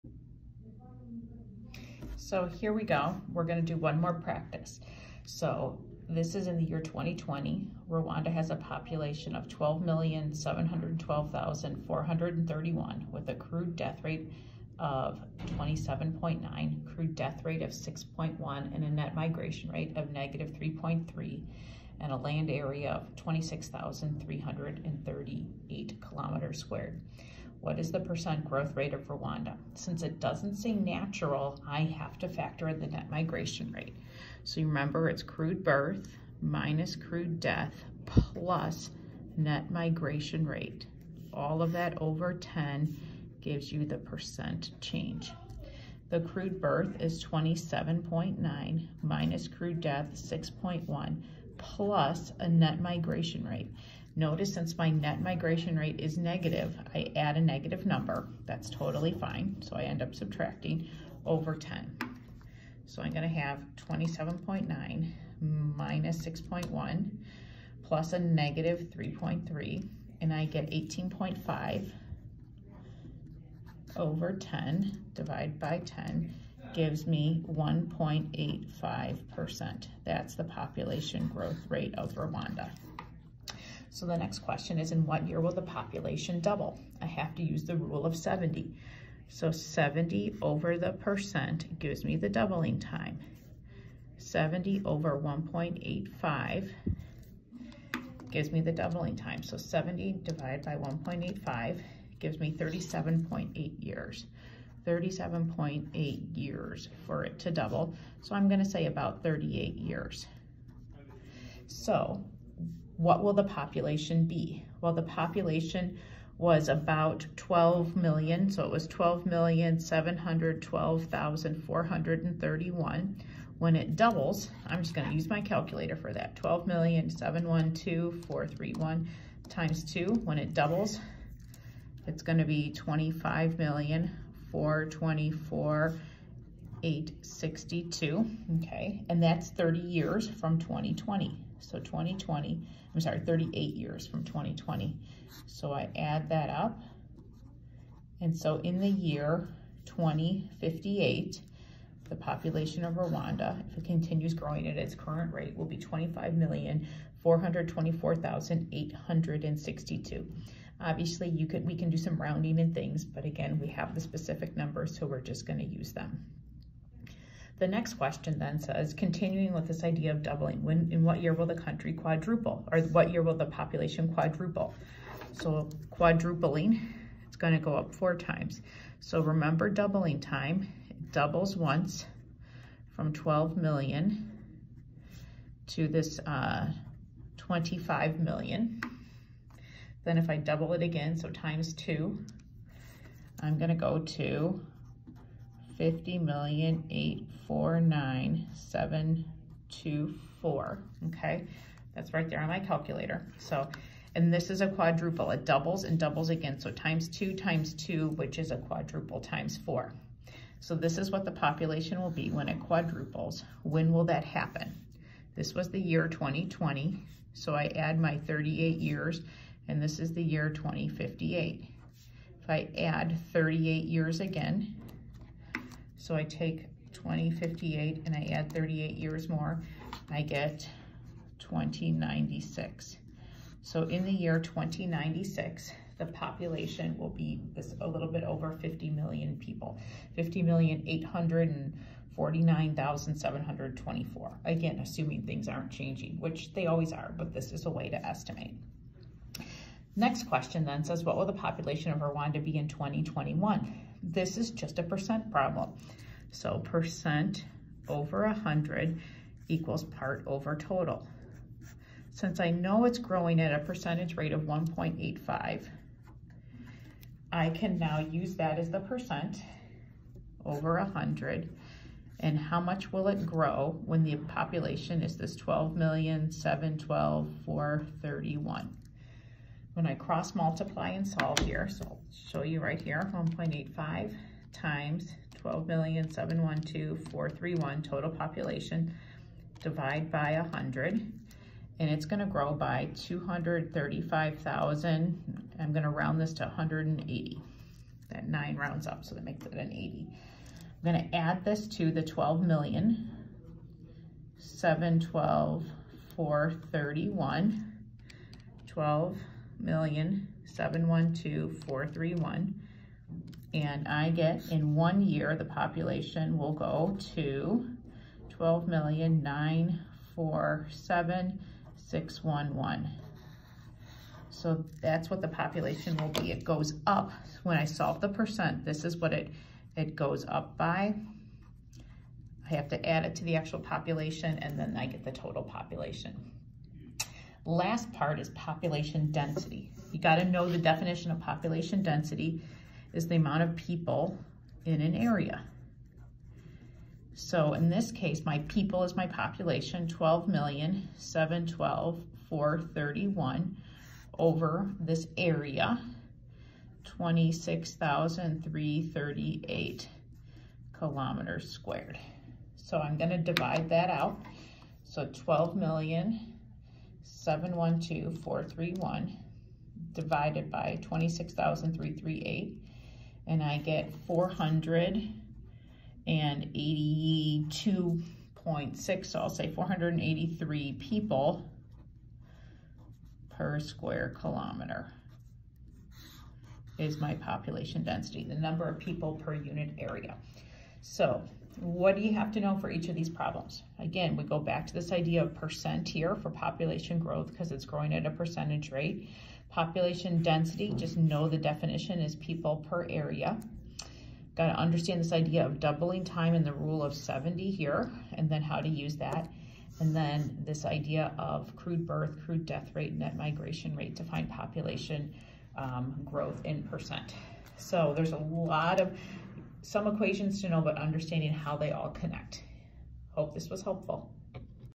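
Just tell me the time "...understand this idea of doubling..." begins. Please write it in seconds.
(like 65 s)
404 s.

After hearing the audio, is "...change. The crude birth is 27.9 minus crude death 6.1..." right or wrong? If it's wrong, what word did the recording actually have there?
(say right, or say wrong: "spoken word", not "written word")
right.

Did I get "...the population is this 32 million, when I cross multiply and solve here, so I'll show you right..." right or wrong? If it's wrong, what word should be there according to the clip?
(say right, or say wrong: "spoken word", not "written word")
wrong: "12", not "32".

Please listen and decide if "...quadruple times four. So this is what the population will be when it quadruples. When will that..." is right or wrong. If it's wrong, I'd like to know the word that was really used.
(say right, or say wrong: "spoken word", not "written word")
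right.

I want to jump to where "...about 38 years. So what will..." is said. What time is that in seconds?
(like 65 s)
108 s.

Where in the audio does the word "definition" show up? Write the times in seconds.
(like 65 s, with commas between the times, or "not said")
340 s, 401 s.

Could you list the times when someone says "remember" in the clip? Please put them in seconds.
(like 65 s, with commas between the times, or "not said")
34 s, 179 s.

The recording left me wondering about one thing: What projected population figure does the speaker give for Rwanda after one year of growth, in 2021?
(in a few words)
12,947,611.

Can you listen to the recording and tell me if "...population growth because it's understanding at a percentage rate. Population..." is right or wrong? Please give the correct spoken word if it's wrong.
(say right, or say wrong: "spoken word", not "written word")
wrong: "growing", not "understanding".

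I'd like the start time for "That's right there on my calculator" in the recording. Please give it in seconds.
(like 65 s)
201 s.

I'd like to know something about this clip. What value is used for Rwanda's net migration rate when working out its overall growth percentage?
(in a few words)
-3.3.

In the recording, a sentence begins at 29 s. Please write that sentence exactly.
Since it doesn't say natural, I have to factor in the net migration rate.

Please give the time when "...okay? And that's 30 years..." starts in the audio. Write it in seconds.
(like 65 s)
138 s.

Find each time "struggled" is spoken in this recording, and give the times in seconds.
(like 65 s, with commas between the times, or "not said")
not said.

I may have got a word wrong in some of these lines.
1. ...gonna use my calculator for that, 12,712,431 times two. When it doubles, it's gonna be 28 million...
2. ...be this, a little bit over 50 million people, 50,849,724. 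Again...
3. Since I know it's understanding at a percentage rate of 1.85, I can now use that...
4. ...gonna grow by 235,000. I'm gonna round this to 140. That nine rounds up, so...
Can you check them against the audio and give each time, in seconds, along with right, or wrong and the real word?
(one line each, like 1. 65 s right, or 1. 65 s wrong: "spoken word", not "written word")
1. 124 s wrong: "25", not "28"
2. 237 s right
3. 262 s wrong: "growing", not "understanding"
4. 292 s wrong: "180", not "140".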